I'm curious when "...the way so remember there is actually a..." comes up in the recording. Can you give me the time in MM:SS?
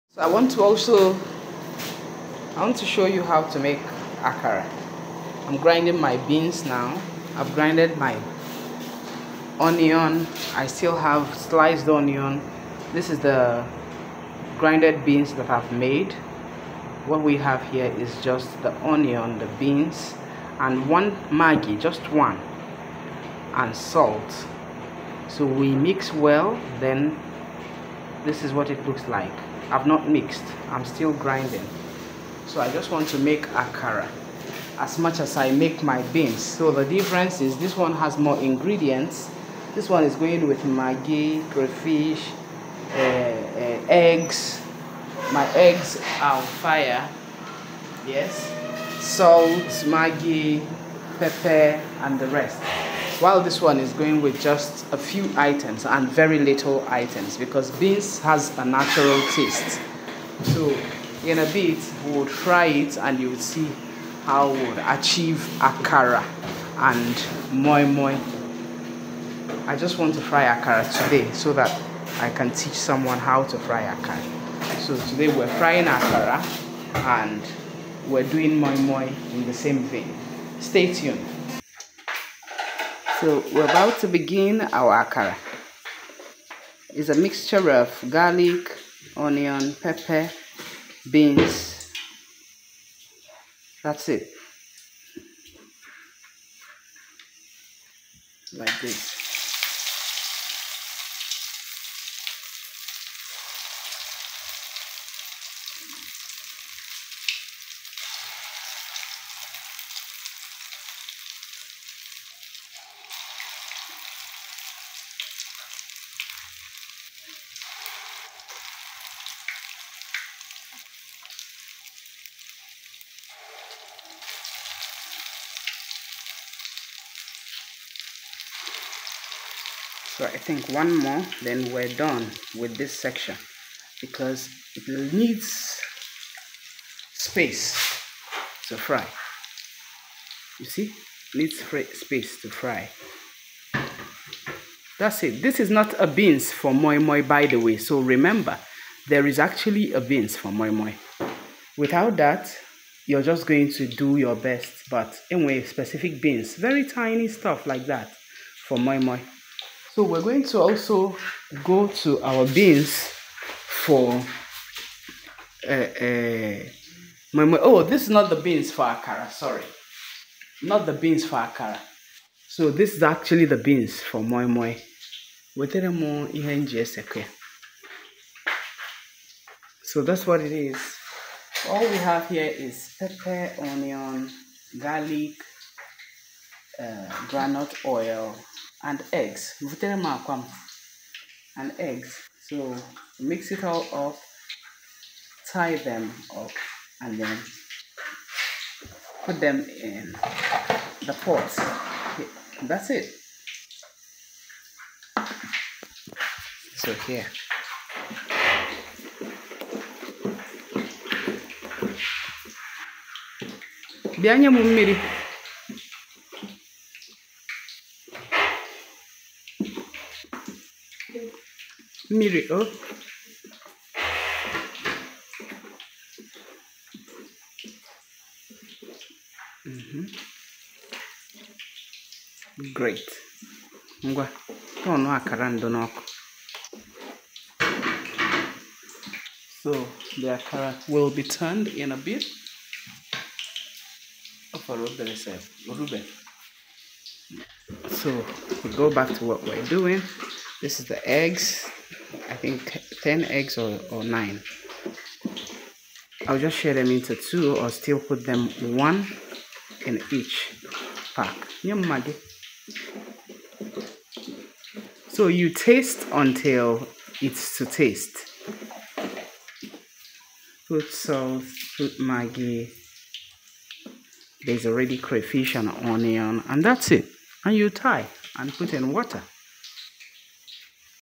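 02:27.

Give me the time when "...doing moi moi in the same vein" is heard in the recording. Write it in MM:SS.
01:18.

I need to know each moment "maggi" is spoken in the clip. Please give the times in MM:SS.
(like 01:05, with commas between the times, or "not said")
00:21, 00:40, 00:49, 04:31.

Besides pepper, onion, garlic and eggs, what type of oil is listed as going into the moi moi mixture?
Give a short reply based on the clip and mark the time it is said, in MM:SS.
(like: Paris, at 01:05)
Groundnut oil, at 03:07.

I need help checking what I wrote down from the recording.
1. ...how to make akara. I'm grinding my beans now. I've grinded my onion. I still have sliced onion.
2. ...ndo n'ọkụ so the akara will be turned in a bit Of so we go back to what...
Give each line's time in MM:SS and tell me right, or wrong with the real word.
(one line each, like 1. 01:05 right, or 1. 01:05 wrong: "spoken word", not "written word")
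1. 00:03 right
2. 03:55 right.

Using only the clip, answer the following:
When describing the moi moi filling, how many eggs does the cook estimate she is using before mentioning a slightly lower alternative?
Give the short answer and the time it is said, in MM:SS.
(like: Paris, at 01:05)
10, at 04:13.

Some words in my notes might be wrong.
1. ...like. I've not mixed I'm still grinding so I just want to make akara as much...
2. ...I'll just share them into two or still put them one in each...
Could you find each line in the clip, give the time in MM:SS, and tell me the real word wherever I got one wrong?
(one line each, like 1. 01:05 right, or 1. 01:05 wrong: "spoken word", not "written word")
1. 00:29 right
2. 04:16 right.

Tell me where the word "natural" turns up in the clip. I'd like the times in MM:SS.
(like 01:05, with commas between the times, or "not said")
00:58.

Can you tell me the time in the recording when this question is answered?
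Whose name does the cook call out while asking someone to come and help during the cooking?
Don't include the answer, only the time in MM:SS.
03:42.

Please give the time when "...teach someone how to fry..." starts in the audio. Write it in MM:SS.
01:12.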